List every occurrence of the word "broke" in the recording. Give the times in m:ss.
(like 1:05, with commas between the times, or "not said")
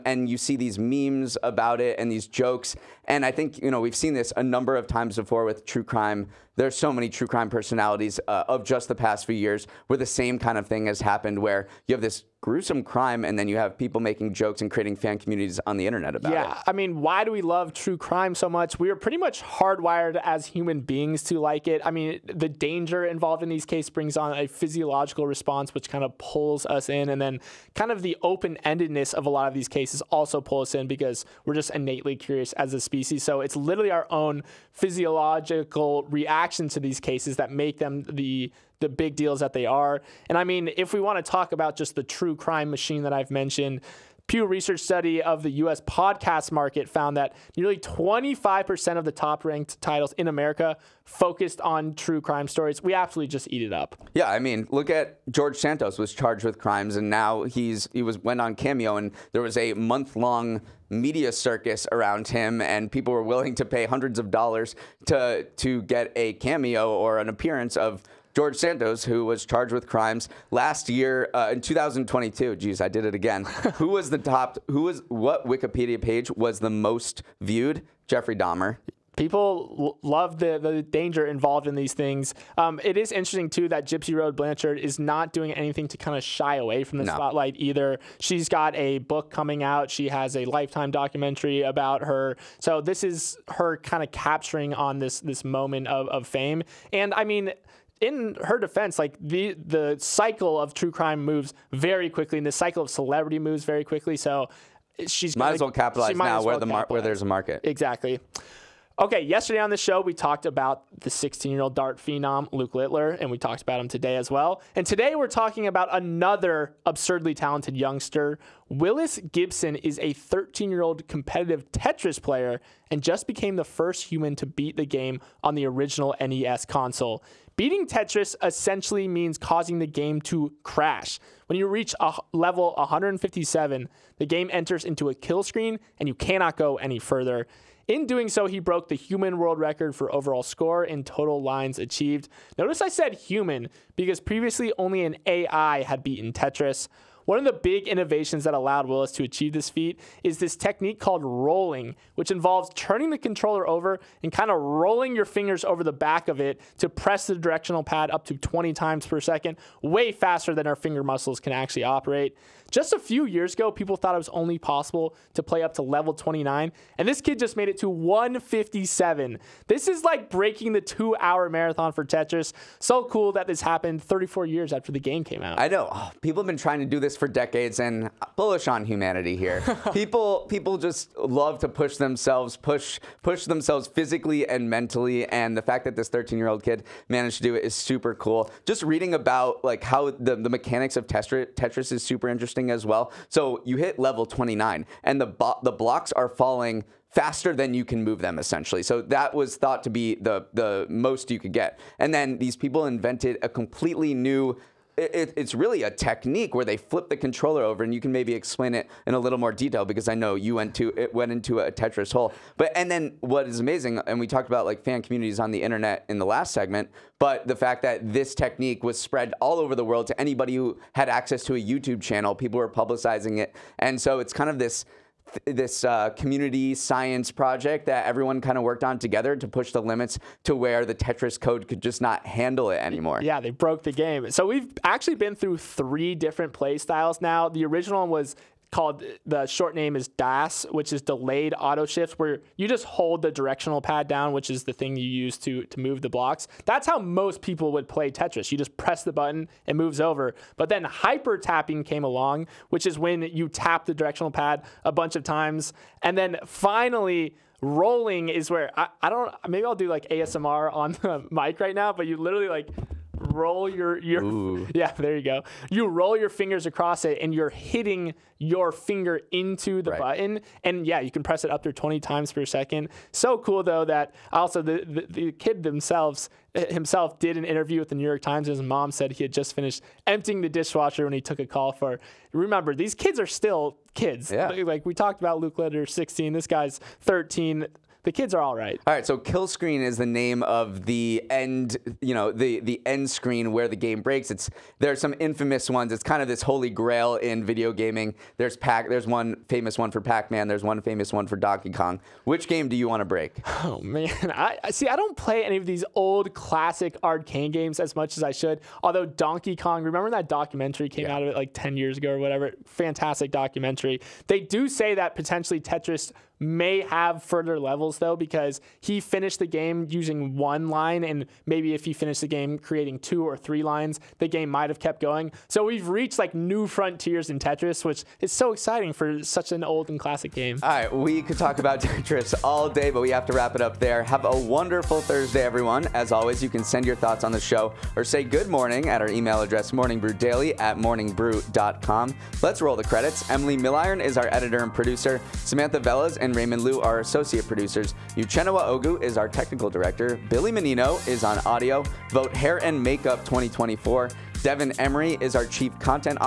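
2:18, 3:53.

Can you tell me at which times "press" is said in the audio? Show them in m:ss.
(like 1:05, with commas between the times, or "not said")
2:36, 4:08, 4:31.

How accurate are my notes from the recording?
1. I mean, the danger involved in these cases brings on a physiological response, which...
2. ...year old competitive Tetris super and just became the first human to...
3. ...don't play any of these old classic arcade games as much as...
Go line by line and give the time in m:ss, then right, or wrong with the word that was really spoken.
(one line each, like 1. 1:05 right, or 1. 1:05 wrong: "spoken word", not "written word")
1. 0:21 right
2. 2:00 wrong: "player", not "super"
3. 5:04 right.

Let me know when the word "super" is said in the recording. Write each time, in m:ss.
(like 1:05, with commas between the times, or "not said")
3:07, 3:12.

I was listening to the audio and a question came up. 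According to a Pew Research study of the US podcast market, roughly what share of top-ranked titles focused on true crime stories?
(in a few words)
25%.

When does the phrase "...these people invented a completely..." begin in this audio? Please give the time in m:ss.
3:22.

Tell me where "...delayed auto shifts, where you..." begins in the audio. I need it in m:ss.
4:01.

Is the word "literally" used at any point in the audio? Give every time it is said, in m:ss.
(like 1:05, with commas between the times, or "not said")
0:33, 4:22.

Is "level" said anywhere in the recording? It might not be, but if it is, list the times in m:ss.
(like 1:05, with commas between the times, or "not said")
2:12, 2:45, 3:13, 5:17.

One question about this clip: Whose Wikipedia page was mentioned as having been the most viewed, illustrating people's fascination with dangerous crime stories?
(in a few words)
Jeffrey Dahmer.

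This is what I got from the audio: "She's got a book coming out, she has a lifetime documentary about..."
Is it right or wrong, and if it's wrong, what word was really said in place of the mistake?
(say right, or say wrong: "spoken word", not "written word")
right.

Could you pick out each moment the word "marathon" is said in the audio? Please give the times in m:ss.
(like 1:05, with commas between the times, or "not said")
2:51.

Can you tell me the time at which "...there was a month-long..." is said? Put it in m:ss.
0:59.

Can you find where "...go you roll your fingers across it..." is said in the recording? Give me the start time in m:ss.
4:25.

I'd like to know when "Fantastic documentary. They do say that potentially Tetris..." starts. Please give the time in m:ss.
5:12.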